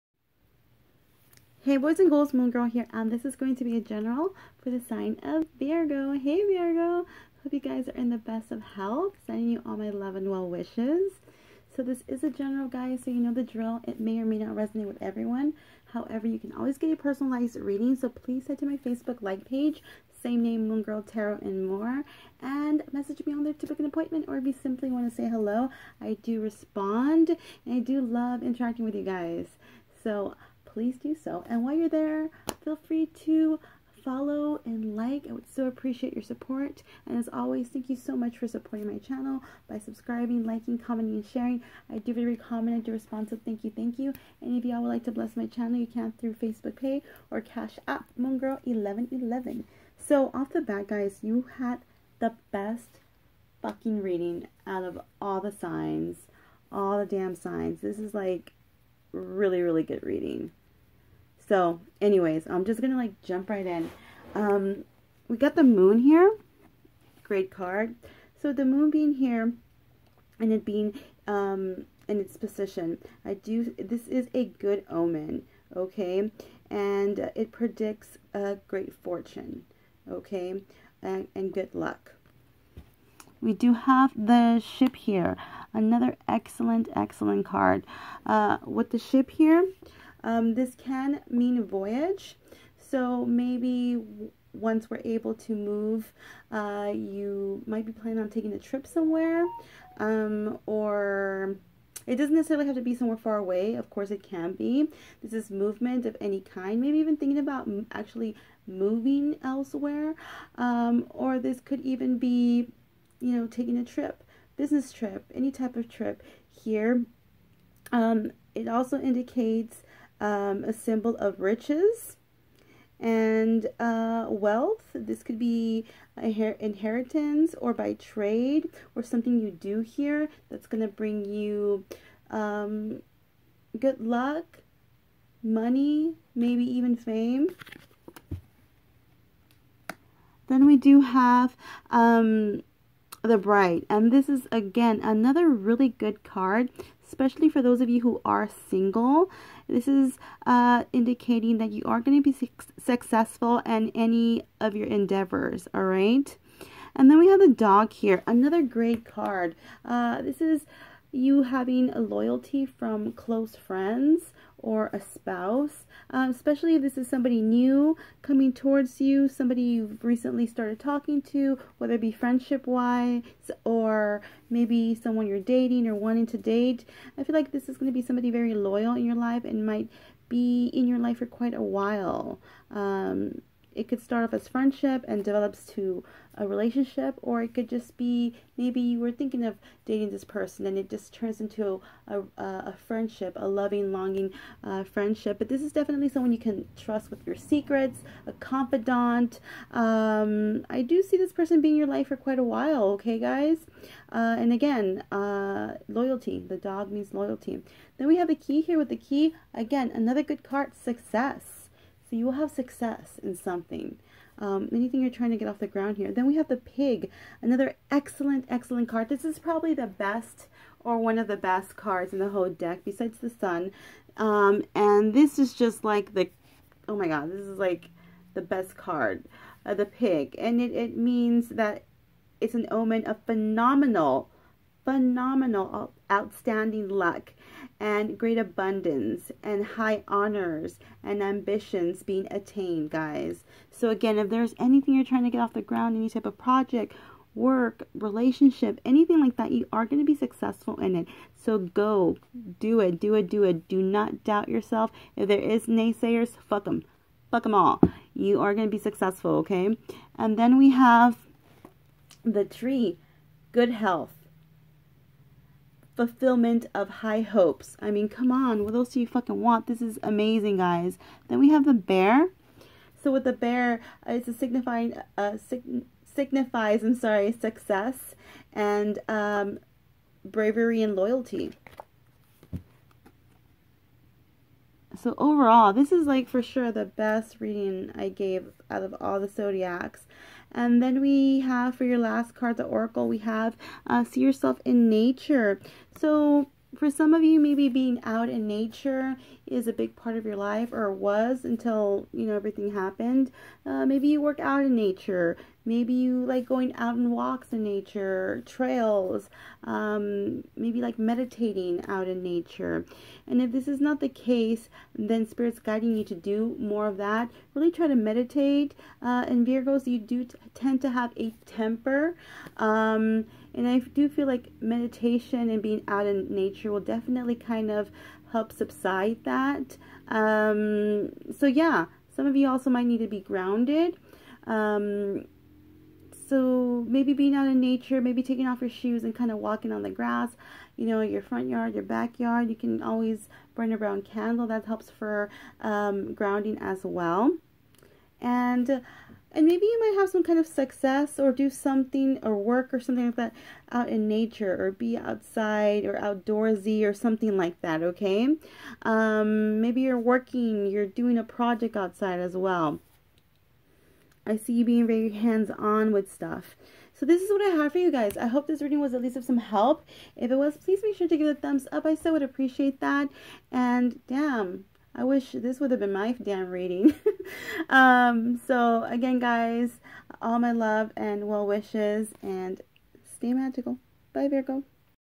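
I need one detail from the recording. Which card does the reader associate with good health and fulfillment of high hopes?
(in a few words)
The tree.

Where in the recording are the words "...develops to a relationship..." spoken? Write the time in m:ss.
3:05.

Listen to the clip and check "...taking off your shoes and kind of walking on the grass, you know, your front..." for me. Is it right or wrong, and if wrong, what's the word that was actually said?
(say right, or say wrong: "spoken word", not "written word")
right.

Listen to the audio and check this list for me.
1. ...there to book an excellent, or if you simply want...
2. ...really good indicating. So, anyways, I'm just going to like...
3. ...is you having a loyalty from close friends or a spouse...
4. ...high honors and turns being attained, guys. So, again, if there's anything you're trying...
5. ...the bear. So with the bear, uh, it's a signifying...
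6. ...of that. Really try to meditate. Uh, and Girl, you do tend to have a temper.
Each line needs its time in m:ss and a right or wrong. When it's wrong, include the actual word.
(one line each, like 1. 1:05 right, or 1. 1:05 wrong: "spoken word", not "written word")
1. 0:23 wrong: "appointment", not "excellent"
2. 0:59 wrong: "reading", not "indicating"
3. 2:40 right
4. 3:59 wrong: "ambitions", not "turns"
5. 4:31 right
6. 5:16 wrong: "Virgos", not "Girl".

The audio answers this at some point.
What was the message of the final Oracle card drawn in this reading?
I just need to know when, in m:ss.
4:54.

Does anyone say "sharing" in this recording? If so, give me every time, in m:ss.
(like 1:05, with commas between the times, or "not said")
0:41.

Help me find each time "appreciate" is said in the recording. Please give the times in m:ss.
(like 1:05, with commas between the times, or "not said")
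0:35, 6:12.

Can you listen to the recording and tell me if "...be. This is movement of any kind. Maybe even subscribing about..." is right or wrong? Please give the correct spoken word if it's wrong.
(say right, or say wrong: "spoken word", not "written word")
wrong: "thinking", not "subscribing".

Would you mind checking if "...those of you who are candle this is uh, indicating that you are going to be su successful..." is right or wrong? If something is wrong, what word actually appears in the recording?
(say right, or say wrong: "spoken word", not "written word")
wrong: "single", not "candle".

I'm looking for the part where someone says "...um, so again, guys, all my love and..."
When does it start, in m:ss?
6:17.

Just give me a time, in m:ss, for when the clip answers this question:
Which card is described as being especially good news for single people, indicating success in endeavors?
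2:23.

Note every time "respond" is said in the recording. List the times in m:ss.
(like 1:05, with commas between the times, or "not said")
0:26, 0:42.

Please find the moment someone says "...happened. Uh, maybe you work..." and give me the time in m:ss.
5:02.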